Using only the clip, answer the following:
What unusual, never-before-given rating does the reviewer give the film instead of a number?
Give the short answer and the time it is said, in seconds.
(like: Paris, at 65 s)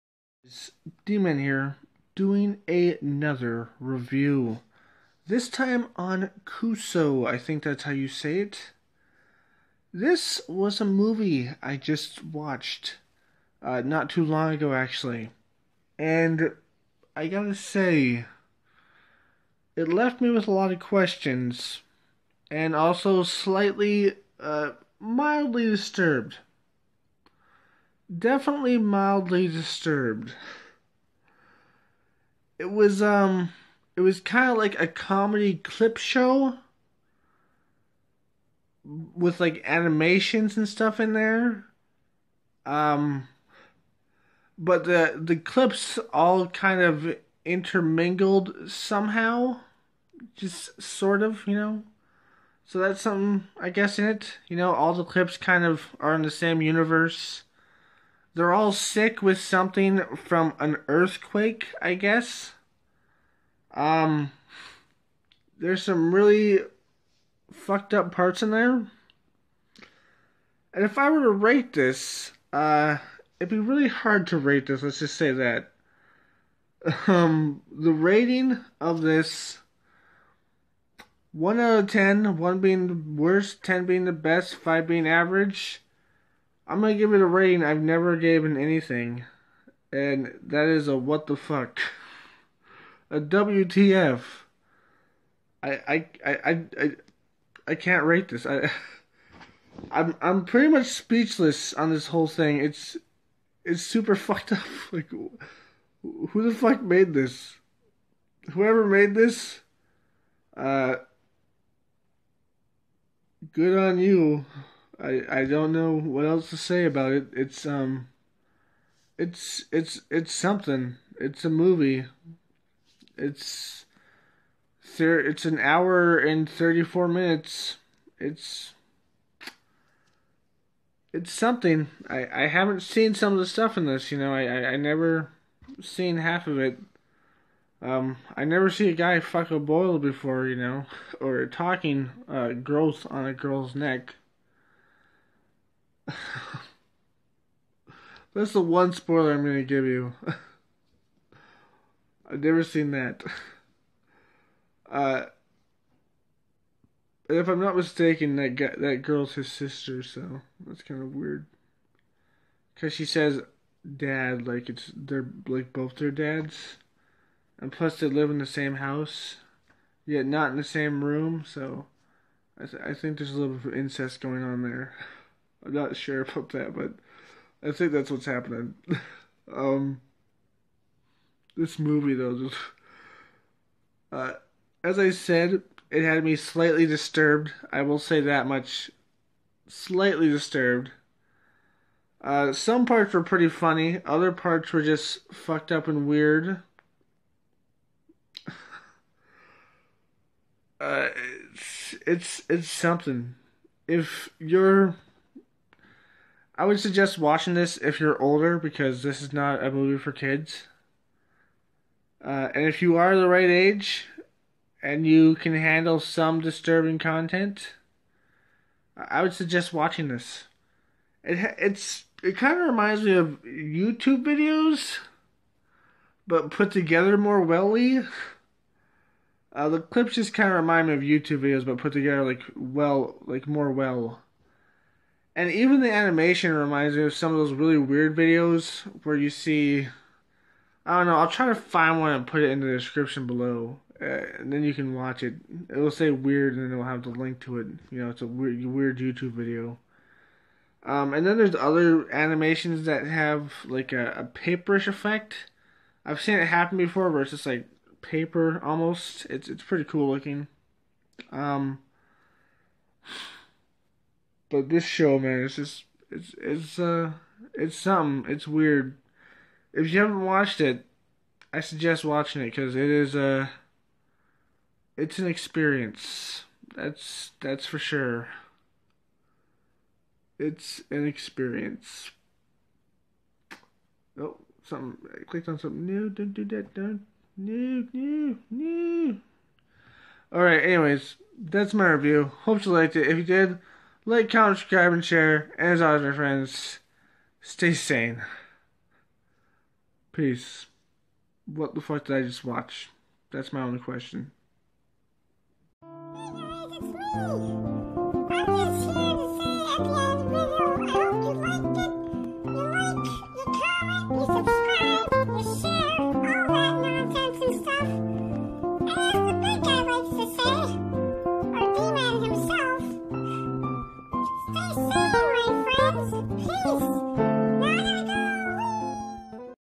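WTF, at 93 s.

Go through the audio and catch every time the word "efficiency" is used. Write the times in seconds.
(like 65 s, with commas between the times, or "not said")
not said.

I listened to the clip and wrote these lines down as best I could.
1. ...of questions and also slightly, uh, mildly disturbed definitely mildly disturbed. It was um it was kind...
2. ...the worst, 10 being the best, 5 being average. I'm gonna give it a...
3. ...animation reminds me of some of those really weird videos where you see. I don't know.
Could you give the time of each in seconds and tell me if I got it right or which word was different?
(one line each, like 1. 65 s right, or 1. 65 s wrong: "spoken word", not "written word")
1. 20 s right
2. 82 s right
3. 235 s right.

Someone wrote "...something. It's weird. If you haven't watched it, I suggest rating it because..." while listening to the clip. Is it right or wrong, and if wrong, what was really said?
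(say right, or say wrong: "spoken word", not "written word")
wrong: "watching", not "rating".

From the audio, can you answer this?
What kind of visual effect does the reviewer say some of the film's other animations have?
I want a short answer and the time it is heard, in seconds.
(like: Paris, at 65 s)
A paperish effect, at 254 s.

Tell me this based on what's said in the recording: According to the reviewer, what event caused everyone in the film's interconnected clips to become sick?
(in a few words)
An earthquake.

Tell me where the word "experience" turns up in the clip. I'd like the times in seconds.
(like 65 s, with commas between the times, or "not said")
275 s, 281 s.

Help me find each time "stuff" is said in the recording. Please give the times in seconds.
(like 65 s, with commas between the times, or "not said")
40 s, 133 s.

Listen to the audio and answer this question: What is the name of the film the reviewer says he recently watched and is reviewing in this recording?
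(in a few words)
Kuso.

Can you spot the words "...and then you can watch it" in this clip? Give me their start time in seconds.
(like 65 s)
244 s.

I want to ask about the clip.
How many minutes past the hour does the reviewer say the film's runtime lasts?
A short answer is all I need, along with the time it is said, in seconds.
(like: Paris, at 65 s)
34, at 126 s.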